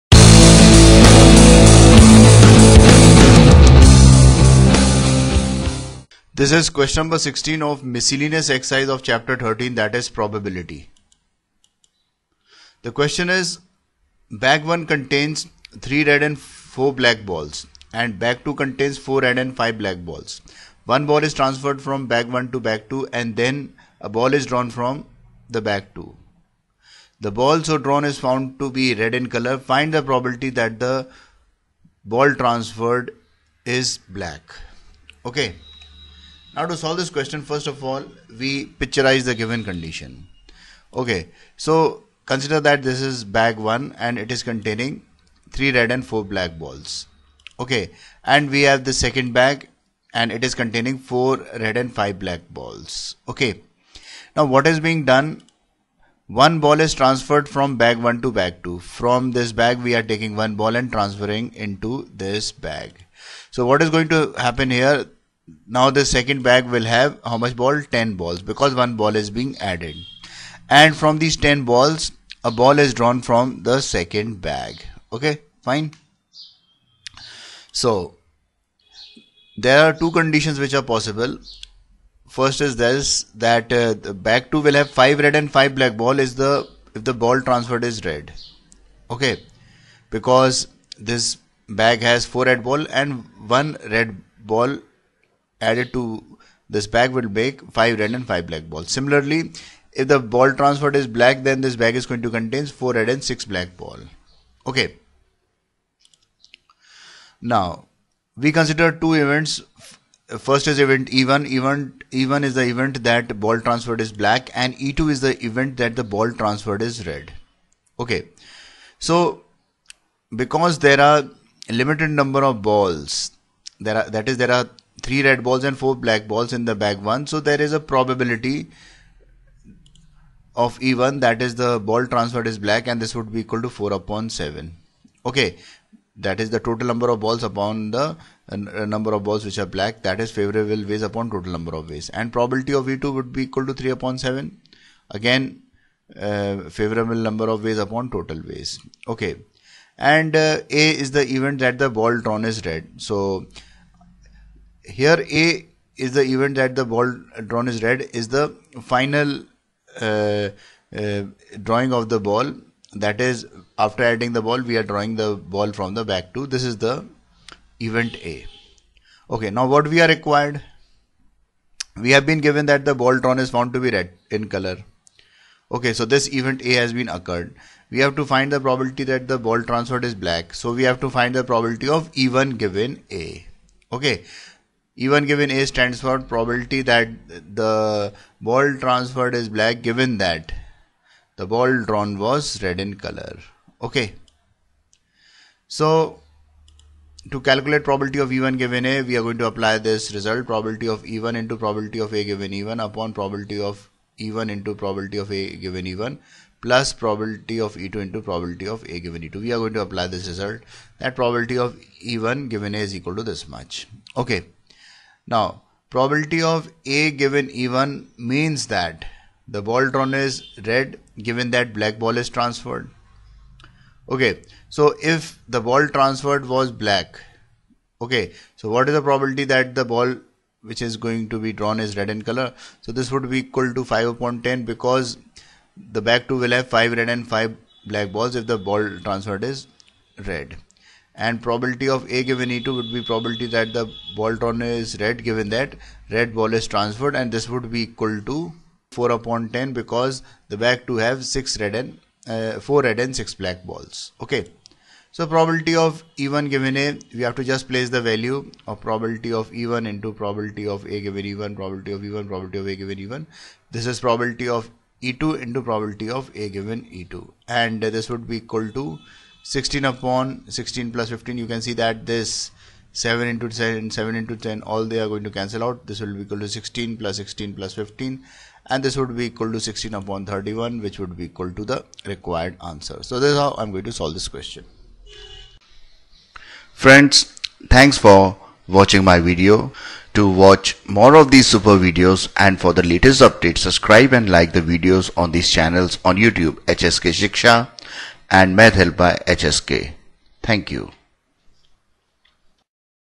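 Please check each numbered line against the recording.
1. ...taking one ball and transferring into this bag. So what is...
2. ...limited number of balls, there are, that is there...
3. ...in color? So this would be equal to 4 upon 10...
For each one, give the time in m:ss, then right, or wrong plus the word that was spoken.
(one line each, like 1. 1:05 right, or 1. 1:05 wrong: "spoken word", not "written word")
1. 1:00 right
2. 2:01 right
3. 3:52 wrong: "5", not "4".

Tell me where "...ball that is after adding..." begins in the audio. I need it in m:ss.
2:42.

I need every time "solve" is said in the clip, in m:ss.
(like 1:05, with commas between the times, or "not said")
0:36, 4:43.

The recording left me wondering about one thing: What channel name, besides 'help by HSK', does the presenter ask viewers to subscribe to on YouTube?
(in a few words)
HSK Shiksha.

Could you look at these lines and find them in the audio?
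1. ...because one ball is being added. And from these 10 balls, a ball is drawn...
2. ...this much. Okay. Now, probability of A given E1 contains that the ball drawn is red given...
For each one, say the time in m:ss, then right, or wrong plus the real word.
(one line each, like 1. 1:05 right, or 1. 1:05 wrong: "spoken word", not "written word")
1. 1:08 right
2. 3:33 wrong: "means", not "contains".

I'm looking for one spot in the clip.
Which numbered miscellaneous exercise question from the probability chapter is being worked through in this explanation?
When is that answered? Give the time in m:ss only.
0:06.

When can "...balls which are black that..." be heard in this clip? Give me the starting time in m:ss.
2:19.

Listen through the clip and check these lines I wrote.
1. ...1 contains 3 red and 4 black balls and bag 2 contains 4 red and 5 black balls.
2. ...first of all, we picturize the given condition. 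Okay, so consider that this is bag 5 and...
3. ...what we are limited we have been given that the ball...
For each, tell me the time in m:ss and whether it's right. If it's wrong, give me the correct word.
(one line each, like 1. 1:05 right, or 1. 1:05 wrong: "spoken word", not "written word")
1. 0:14 right
2. 0:37 wrong: "1", not "5"
3. 2:49 wrong: "required", not "limited".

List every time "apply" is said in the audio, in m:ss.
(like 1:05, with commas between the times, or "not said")
3:19, 3:29.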